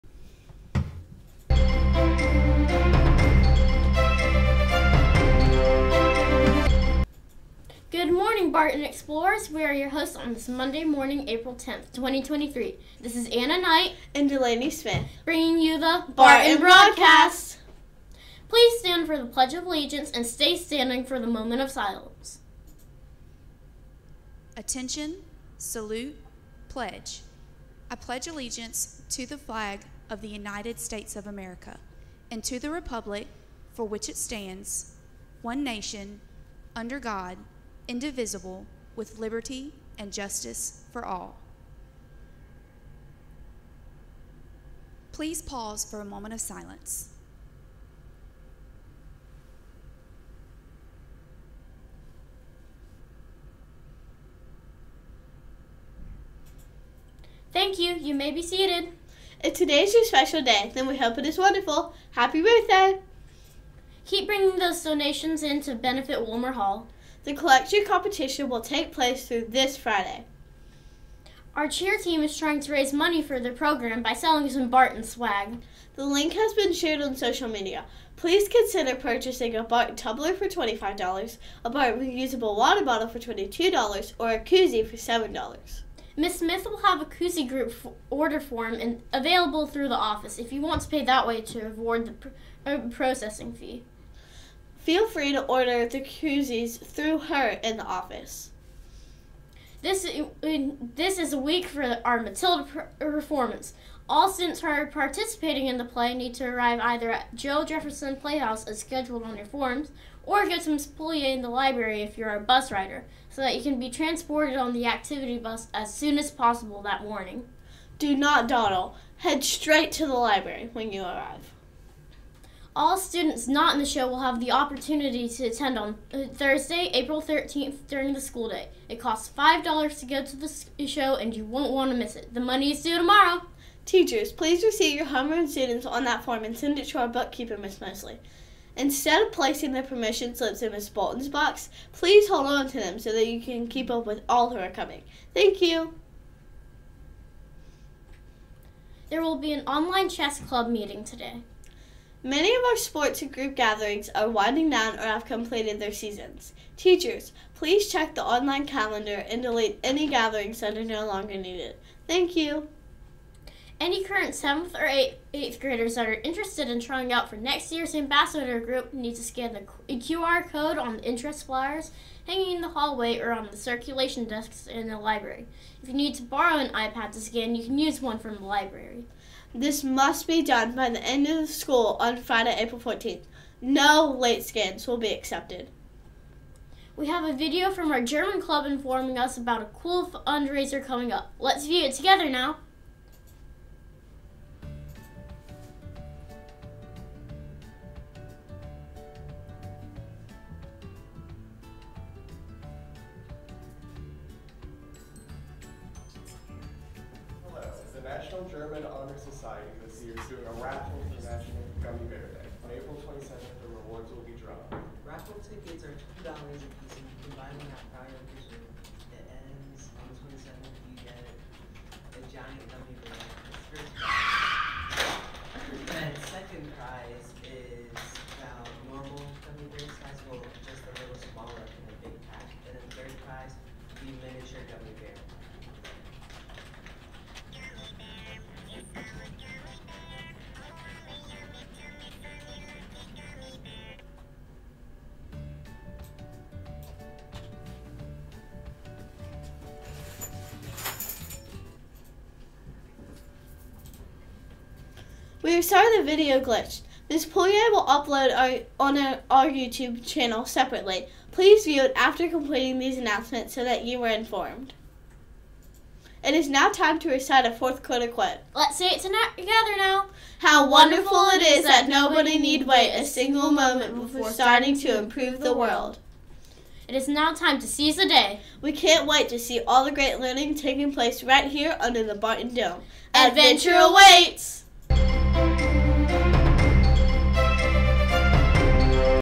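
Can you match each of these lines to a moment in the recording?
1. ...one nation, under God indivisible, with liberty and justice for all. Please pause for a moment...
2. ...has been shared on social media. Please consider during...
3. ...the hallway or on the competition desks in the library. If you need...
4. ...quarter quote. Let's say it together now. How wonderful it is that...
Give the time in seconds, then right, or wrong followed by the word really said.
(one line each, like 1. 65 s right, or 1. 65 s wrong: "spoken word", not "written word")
1. 35 s right
2. 76 s wrong: "purchasing", not "during"
3. 172 s wrong: "circulation", not "competition"
4. 267 s right.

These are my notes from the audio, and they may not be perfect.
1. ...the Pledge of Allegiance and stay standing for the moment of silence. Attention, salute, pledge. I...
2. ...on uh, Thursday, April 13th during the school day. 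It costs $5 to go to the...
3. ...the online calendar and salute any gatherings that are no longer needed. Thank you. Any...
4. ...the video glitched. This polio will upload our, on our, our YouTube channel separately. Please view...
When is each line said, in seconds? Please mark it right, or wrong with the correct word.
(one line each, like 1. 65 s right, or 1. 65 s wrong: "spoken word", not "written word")
1. 19 s right
2. 125 s right
3. 158 s wrong: "delete", not "salute"
4. 255 s right.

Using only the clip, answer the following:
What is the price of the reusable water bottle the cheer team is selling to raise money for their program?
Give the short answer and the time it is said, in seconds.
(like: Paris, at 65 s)
$22, at 83 s.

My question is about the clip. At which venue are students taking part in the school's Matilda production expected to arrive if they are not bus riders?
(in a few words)
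Joe Jefferson Playhouse.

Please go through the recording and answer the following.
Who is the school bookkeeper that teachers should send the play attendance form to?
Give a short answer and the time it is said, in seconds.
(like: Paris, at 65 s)
Miss Mosley, at 137 s.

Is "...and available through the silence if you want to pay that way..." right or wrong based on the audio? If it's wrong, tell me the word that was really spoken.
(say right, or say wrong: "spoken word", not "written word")
wrong: "office", not "silence".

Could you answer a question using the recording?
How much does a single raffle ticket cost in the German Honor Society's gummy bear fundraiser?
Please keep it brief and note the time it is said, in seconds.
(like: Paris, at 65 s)
$2, at 216 s.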